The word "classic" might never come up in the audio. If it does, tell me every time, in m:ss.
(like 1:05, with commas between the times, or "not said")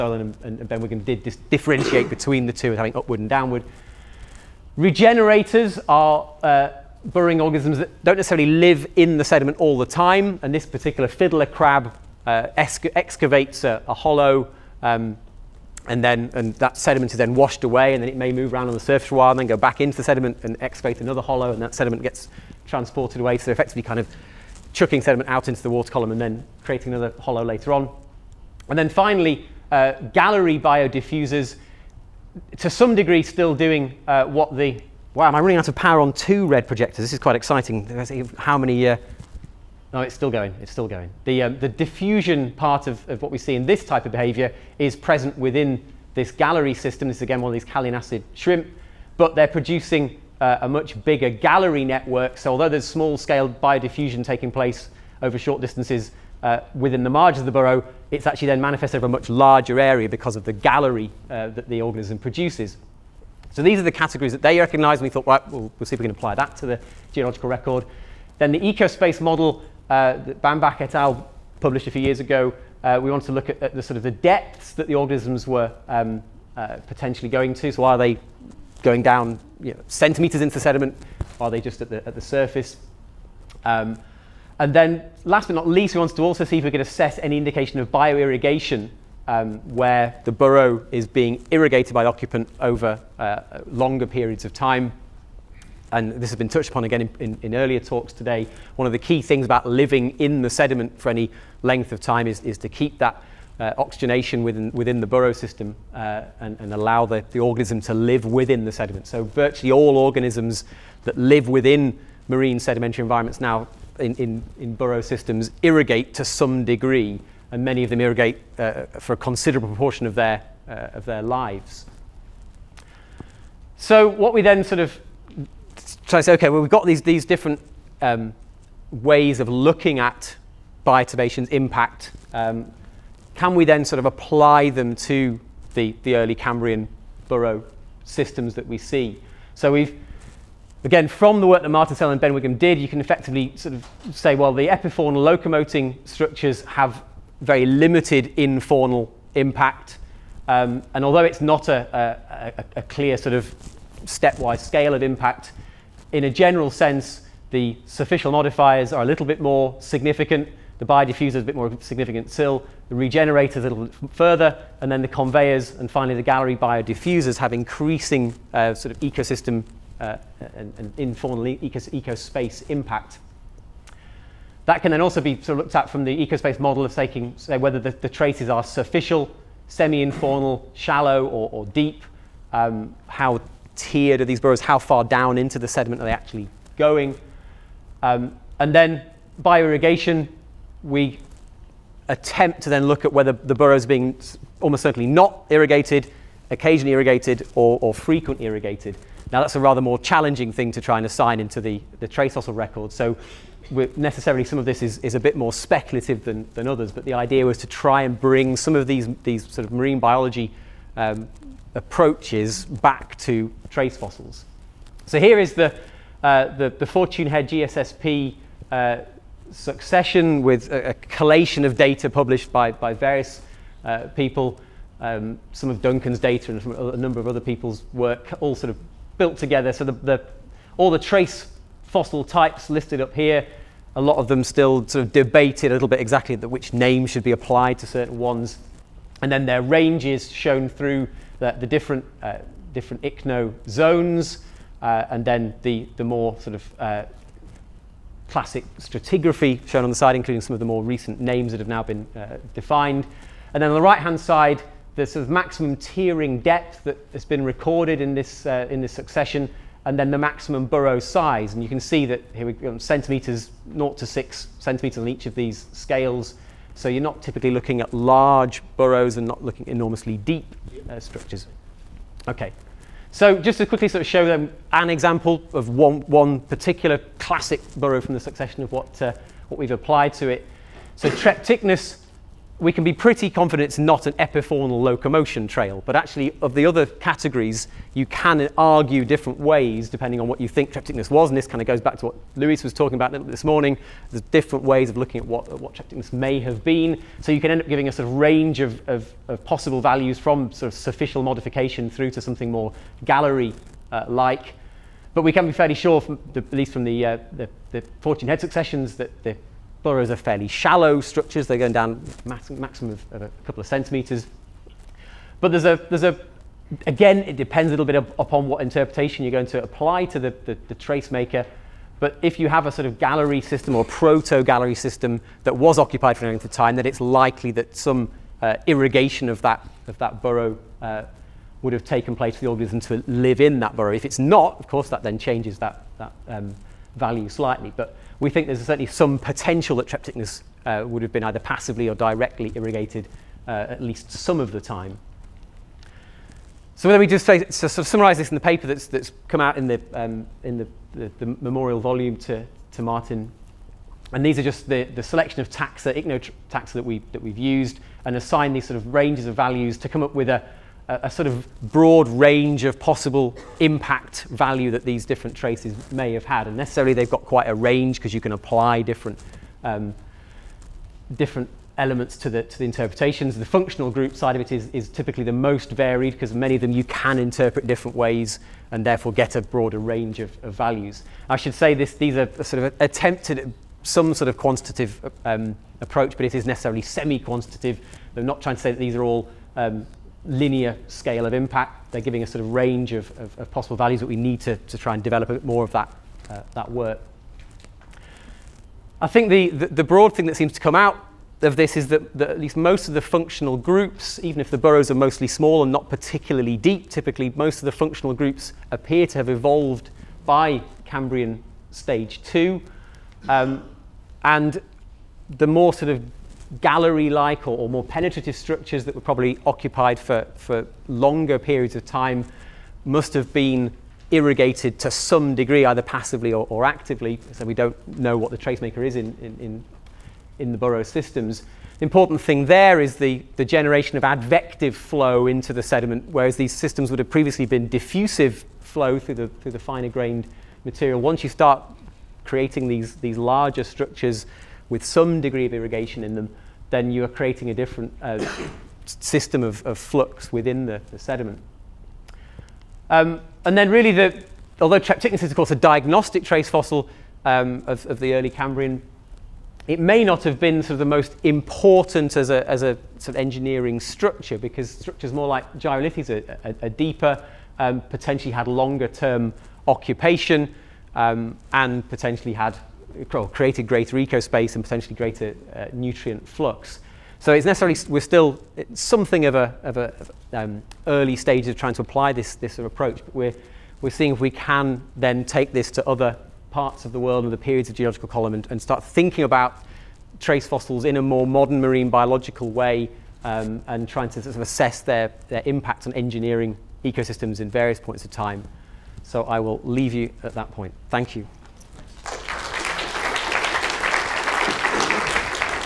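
4:08, 4:37.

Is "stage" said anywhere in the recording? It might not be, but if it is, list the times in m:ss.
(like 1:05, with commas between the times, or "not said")
6:51, 8:01.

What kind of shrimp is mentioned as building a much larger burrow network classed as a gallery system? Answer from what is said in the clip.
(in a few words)
Callianassid shrimp.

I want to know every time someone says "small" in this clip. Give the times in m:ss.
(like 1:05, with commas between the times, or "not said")
0:52, 6:45.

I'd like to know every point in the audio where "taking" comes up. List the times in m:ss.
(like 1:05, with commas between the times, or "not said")
0:54, 2:56.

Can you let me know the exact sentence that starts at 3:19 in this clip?
Now, that's a rather more challenging thing to try and assign into the, the trace fossil record.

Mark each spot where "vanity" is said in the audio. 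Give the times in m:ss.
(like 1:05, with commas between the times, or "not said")
not said.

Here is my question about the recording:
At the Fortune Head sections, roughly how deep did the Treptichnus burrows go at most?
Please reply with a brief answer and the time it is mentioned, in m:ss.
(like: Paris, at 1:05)
A couple of centimetres, at 5:13.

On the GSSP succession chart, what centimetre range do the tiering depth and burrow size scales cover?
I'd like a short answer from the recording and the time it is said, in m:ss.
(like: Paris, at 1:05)
0 to 6 centimetres, at 4:23.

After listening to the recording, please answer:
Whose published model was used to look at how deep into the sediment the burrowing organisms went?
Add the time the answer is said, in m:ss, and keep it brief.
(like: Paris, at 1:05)
Bambach et al., at 1:10.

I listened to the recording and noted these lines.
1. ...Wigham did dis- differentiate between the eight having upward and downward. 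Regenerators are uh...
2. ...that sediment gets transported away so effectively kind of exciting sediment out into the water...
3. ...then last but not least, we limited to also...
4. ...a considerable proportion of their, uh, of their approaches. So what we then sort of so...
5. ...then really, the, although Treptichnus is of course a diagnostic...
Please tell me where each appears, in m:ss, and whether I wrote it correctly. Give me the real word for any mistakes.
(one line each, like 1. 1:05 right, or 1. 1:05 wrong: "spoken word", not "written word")
1. 0:00 wrong: "two", not "eight"
2. 0:21 wrong: "chucking", not "exciting"
3. 1:24 wrong: "wanted", not "limited"
4. 1:59 wrong: "lives", not "approaches"
5. 7:33 right.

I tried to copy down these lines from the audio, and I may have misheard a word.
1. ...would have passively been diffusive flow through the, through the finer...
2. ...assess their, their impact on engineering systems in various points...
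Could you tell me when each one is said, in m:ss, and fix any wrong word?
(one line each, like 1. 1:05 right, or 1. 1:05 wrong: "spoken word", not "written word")
1. 7:16 wrong: "previously", not "passively"
2. 8:14 wrong: "ecosystems", not "systems".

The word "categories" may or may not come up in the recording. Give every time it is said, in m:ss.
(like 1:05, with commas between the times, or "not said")
1:03, 4:46.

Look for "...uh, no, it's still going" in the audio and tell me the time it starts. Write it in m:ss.
0:38.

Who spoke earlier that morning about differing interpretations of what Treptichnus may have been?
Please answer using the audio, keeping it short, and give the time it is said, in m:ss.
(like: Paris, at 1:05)
Luis, at 4:52.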